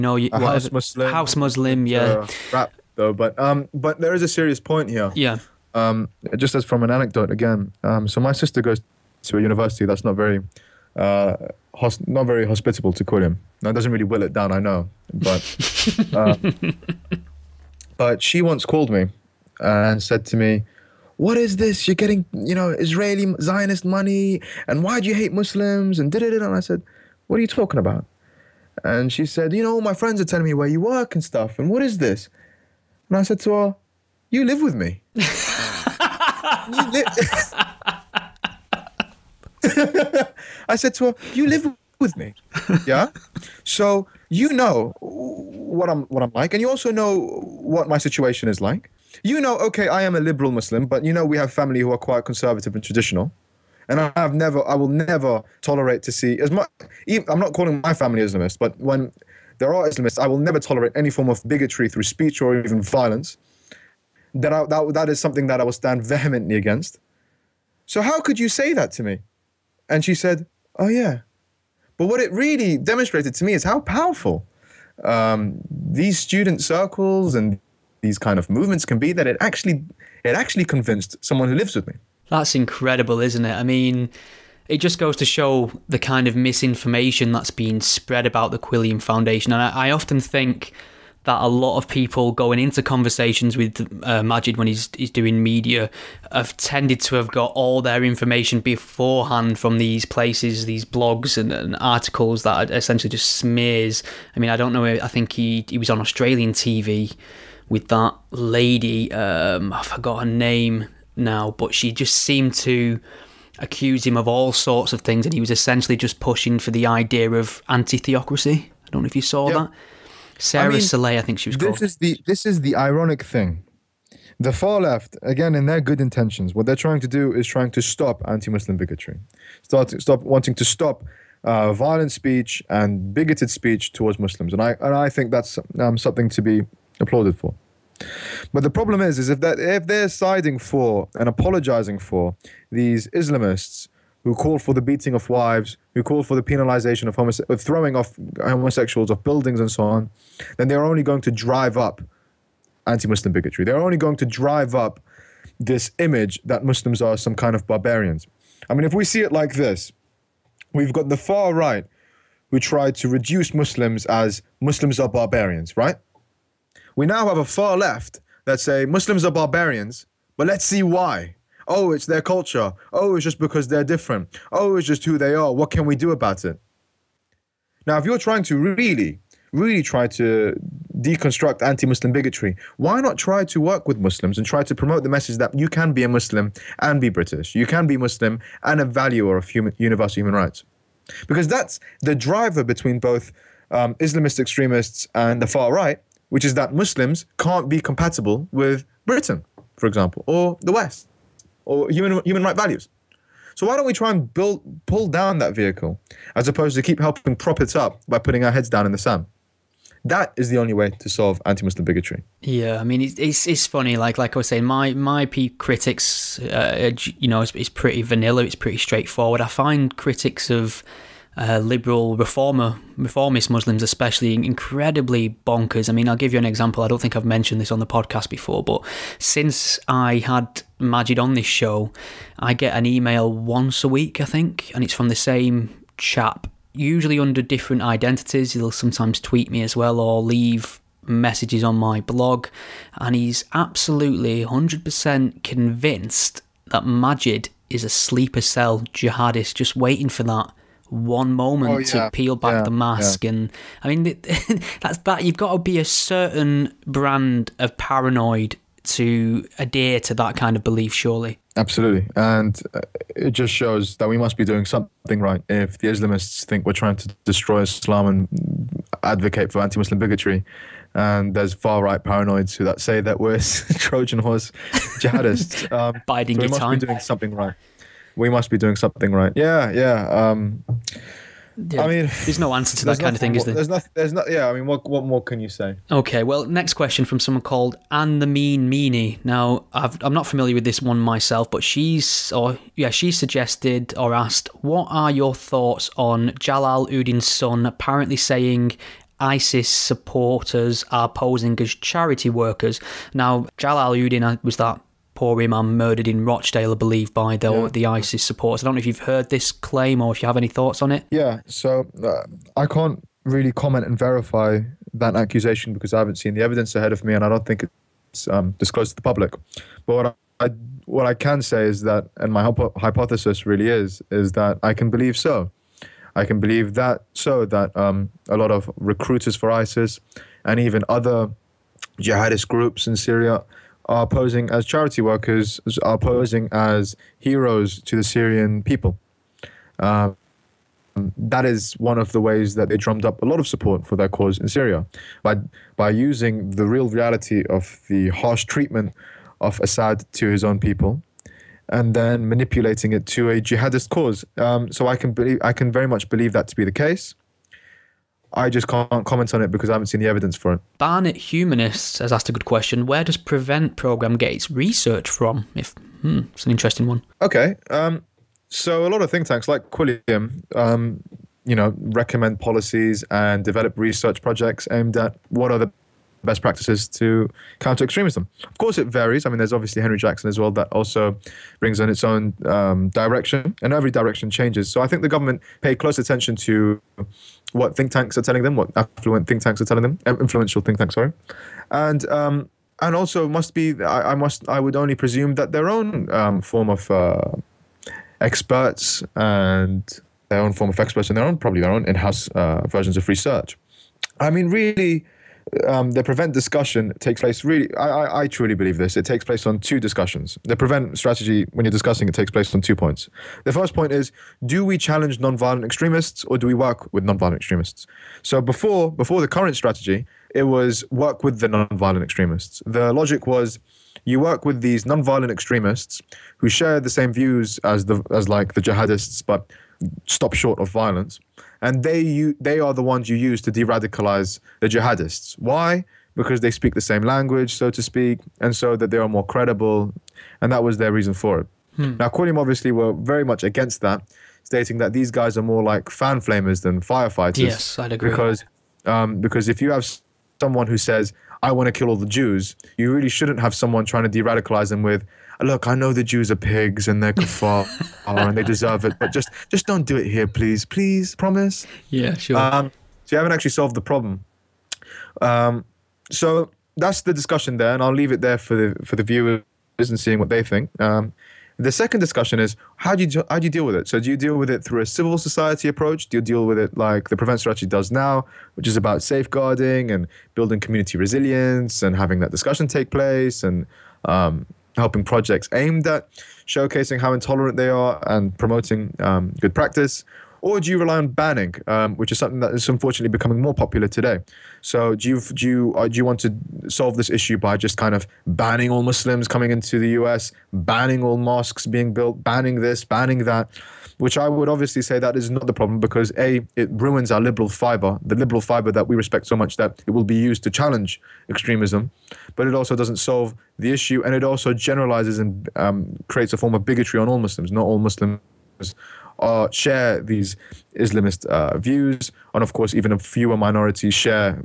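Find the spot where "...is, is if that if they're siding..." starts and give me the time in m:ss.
2:18.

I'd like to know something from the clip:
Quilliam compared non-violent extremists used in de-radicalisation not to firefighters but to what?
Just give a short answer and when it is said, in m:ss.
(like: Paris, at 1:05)
fan flamers, at 7:25.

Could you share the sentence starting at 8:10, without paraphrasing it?
Or do you rely on banning, um, which is something that is unfortunately becoming more popular today?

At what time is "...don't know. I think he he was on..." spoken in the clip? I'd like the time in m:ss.
1:44.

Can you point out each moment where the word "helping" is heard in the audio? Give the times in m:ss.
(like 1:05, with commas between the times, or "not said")
3:26, 8:04.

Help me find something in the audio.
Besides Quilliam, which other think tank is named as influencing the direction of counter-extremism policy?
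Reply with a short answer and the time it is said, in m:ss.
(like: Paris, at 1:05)
Henry Jackson, at 6:19.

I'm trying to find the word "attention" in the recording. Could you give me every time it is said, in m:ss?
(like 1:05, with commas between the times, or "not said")
6:25.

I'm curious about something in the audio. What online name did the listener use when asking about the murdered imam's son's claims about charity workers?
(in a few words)
Anne the Mean Meanie.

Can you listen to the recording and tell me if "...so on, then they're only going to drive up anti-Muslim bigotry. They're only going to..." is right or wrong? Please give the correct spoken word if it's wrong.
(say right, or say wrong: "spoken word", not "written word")
right.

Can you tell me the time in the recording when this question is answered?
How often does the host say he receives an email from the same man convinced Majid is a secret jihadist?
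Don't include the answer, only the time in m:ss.
3:53.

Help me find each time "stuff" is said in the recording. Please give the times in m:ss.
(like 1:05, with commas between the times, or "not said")
0:31.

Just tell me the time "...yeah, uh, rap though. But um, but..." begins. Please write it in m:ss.
0:01.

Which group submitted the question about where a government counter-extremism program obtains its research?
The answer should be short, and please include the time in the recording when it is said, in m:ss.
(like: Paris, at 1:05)
Barnet Humanists, at 6:00.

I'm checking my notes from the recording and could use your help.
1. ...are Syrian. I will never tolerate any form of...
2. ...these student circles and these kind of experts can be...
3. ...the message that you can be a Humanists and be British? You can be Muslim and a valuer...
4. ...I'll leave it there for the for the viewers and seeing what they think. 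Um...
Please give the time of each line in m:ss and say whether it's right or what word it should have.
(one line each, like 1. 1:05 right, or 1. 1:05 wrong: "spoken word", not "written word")
1. 0:59 wrong: "Islamists", not "Syrian"
2. 1:15 wrong: "movements", not "experts"
3. 3:05 wrong: "Muslim", not "Humanists"
4. 7:47 right.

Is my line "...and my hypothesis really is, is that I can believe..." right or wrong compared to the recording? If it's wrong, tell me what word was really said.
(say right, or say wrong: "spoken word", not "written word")
right.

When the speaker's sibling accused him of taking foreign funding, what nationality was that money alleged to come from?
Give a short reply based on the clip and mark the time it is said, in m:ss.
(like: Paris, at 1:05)
Israeli, at 0:22.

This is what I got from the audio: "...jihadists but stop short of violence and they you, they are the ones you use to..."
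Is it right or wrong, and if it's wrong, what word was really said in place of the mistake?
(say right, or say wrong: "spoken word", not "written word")
right.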